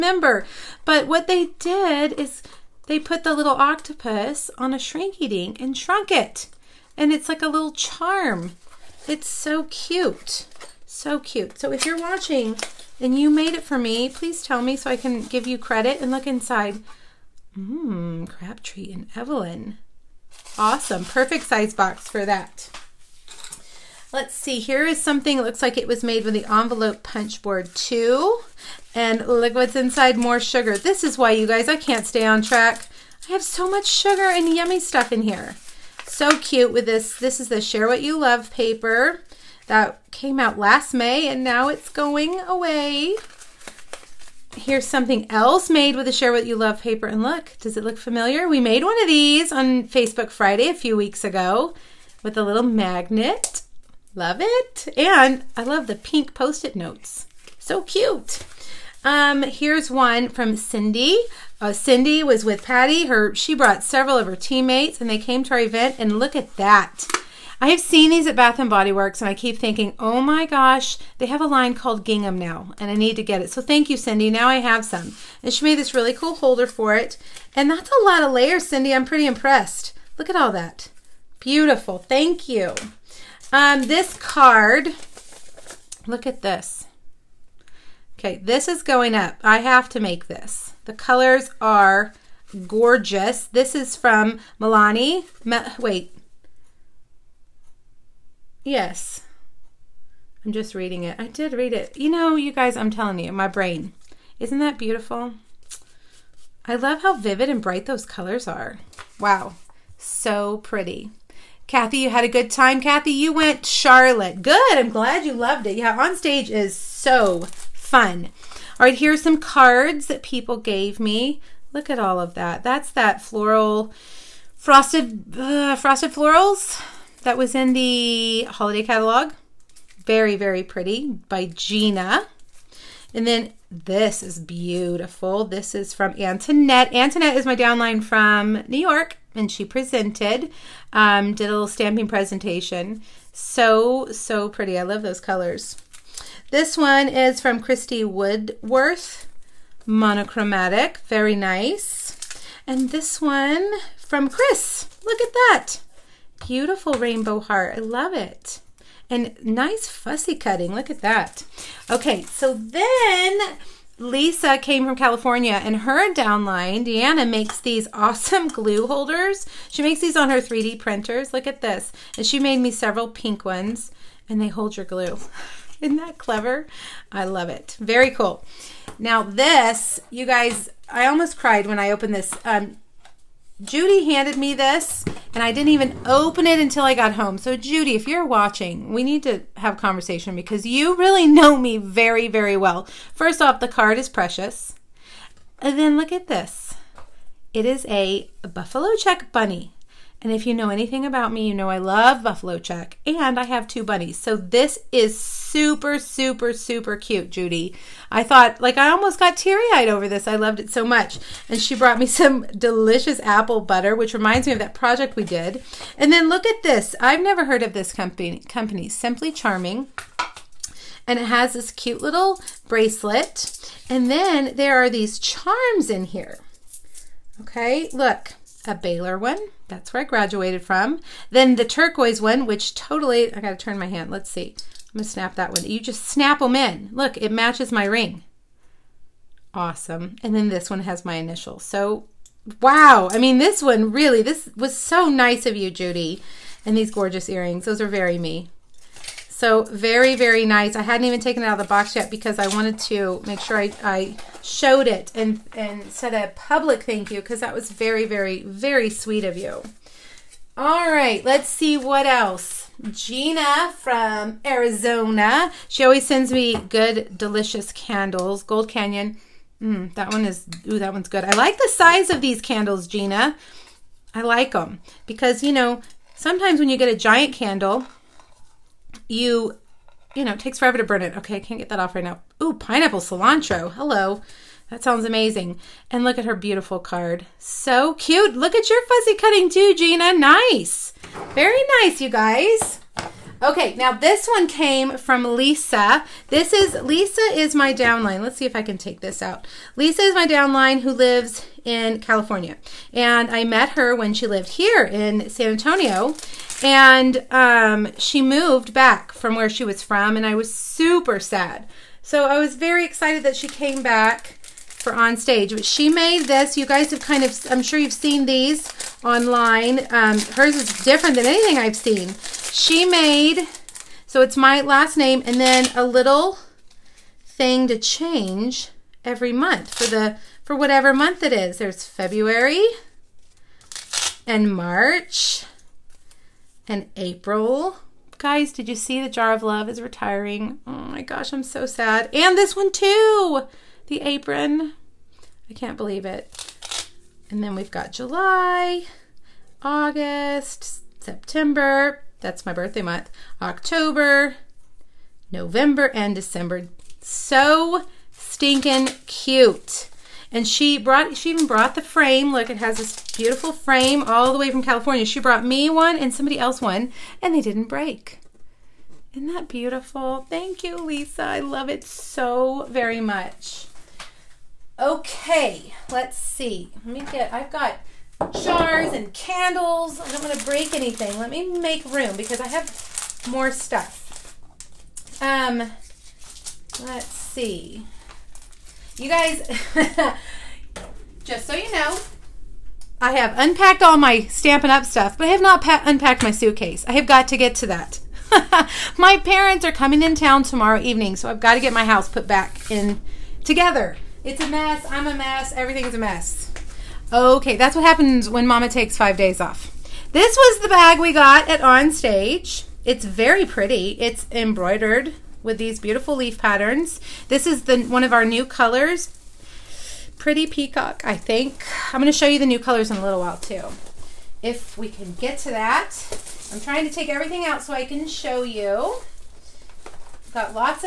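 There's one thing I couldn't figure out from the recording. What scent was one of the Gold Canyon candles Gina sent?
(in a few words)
Pineapple cilantro.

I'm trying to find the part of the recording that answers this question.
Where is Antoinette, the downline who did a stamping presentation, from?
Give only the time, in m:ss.
2:18.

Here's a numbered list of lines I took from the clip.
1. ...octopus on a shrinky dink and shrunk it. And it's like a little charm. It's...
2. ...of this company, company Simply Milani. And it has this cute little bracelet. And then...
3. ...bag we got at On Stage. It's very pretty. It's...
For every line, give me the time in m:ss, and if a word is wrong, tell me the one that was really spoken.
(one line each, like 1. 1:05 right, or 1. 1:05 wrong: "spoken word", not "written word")
1. 0:03 right
2. 3:37 wrong: "Charming", not "Milani"
3. 6:50 right.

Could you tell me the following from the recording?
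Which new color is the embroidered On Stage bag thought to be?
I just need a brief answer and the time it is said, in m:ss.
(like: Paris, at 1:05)
Pretty peacock, at 7:00.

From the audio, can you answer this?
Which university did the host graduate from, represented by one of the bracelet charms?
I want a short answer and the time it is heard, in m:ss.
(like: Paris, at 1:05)
Baylor, at 3:48.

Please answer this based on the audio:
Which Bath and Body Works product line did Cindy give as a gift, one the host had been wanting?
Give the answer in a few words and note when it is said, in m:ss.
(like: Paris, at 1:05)
Gingham, at 1:12.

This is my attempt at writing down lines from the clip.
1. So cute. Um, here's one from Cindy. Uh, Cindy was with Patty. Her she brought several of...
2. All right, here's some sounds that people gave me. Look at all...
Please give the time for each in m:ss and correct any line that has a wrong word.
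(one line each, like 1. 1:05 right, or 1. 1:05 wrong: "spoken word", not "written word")
1. 0:57 right
2. 1:58 wrong: "cards", not "sounds".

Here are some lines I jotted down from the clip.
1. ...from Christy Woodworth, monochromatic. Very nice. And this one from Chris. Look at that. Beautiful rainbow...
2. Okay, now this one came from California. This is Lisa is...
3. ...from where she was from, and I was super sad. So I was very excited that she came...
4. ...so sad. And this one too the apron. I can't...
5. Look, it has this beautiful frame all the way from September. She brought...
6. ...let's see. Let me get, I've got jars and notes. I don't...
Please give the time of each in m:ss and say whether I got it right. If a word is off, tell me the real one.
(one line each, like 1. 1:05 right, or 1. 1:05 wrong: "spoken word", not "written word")
1. 2:27 right
2. 4:53 wrong: "Lisa", not "California"
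3. 5:09 right
4. 5:41 right
5. 6:02 wrong: "California", not "September"
6. 6:15 wrong: "candles", not "notes".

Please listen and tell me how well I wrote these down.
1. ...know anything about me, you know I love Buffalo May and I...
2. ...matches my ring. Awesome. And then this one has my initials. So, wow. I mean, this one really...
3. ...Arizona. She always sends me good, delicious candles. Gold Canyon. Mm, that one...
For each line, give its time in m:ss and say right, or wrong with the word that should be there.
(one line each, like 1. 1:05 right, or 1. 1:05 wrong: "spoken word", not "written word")
1. 3:20 wrong: "Check", not "May"
2. 3:57 right
3. 4:24 right.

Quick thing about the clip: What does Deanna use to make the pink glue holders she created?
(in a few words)
3D printers.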